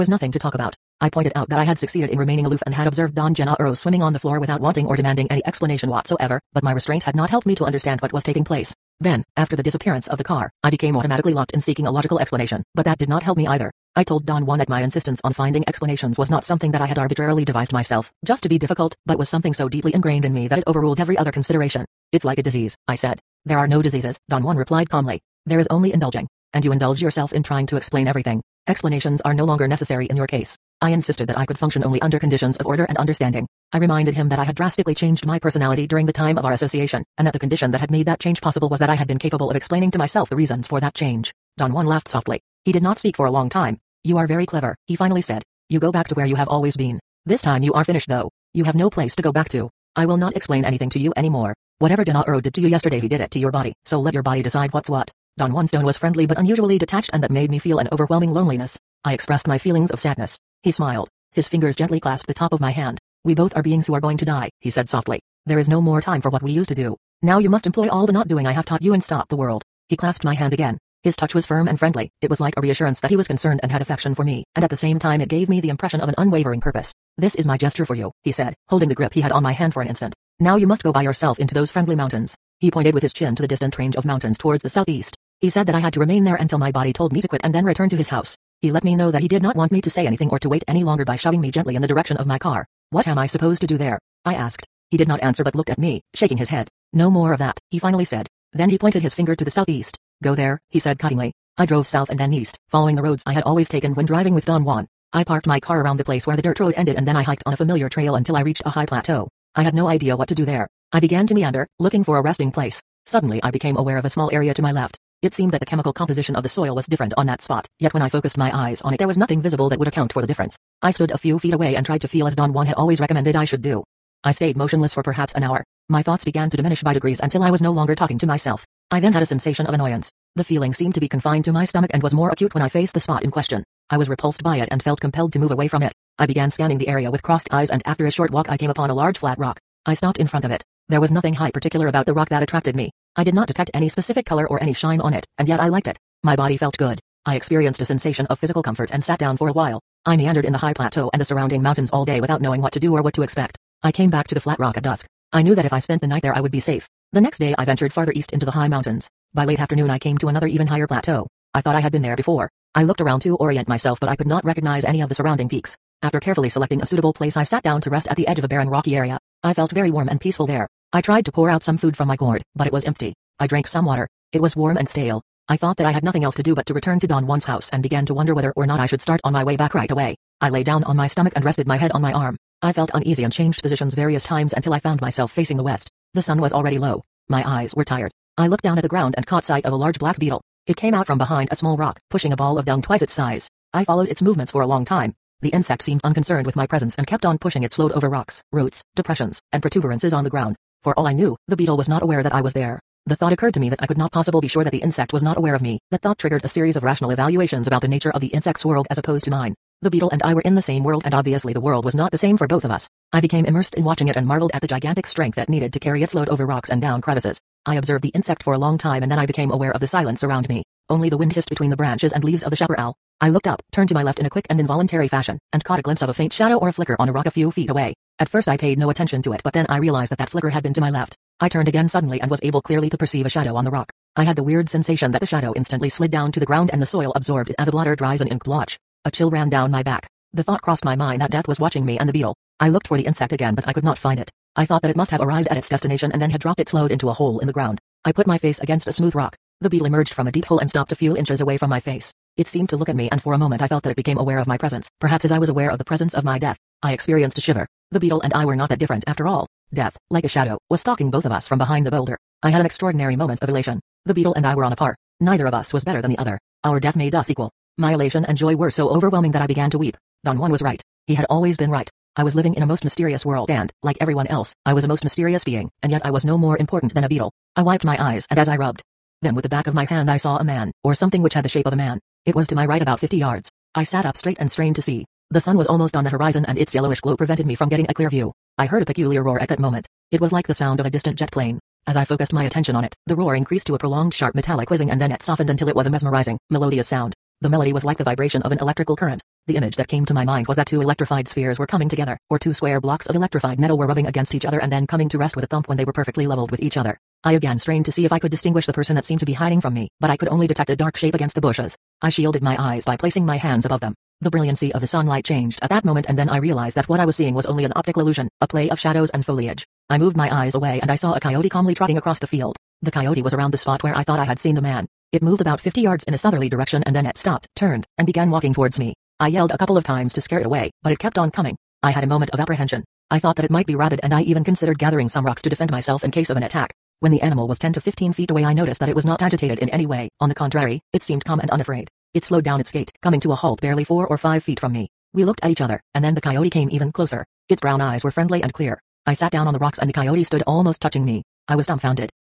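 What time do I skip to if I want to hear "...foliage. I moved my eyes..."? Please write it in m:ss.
5:19.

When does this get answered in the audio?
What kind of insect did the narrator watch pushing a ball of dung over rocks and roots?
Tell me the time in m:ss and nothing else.
3:09.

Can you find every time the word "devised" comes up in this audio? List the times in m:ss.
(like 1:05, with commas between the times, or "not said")
0:17.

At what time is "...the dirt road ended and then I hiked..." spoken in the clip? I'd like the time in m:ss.
1:46.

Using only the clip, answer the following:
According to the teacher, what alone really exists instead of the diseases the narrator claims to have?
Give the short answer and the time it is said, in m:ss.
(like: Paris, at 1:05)
Indulging, at 0:25.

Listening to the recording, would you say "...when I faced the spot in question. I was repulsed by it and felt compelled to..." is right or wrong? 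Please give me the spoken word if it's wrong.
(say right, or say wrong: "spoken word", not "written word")
right.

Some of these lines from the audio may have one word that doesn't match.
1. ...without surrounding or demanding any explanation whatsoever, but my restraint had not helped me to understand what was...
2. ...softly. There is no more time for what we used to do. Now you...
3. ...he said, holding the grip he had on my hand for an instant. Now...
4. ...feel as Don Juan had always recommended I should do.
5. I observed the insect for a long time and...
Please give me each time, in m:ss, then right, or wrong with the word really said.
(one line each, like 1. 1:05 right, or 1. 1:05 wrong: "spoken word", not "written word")
1. 0:04 wrong: "wanting", not "surrounding"
2. 1:04 right
3. 1:18 right
4. 2:02 right
5. 3:37 right.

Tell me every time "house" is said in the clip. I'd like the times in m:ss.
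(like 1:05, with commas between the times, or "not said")
1:28, 2:57.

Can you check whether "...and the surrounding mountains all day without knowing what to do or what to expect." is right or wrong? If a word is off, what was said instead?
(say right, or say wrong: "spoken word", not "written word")
right.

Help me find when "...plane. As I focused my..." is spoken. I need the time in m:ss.
4:51.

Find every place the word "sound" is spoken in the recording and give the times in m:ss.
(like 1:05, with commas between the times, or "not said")
4:50, 4:56.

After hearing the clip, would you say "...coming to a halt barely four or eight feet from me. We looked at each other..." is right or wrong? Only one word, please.
wrong.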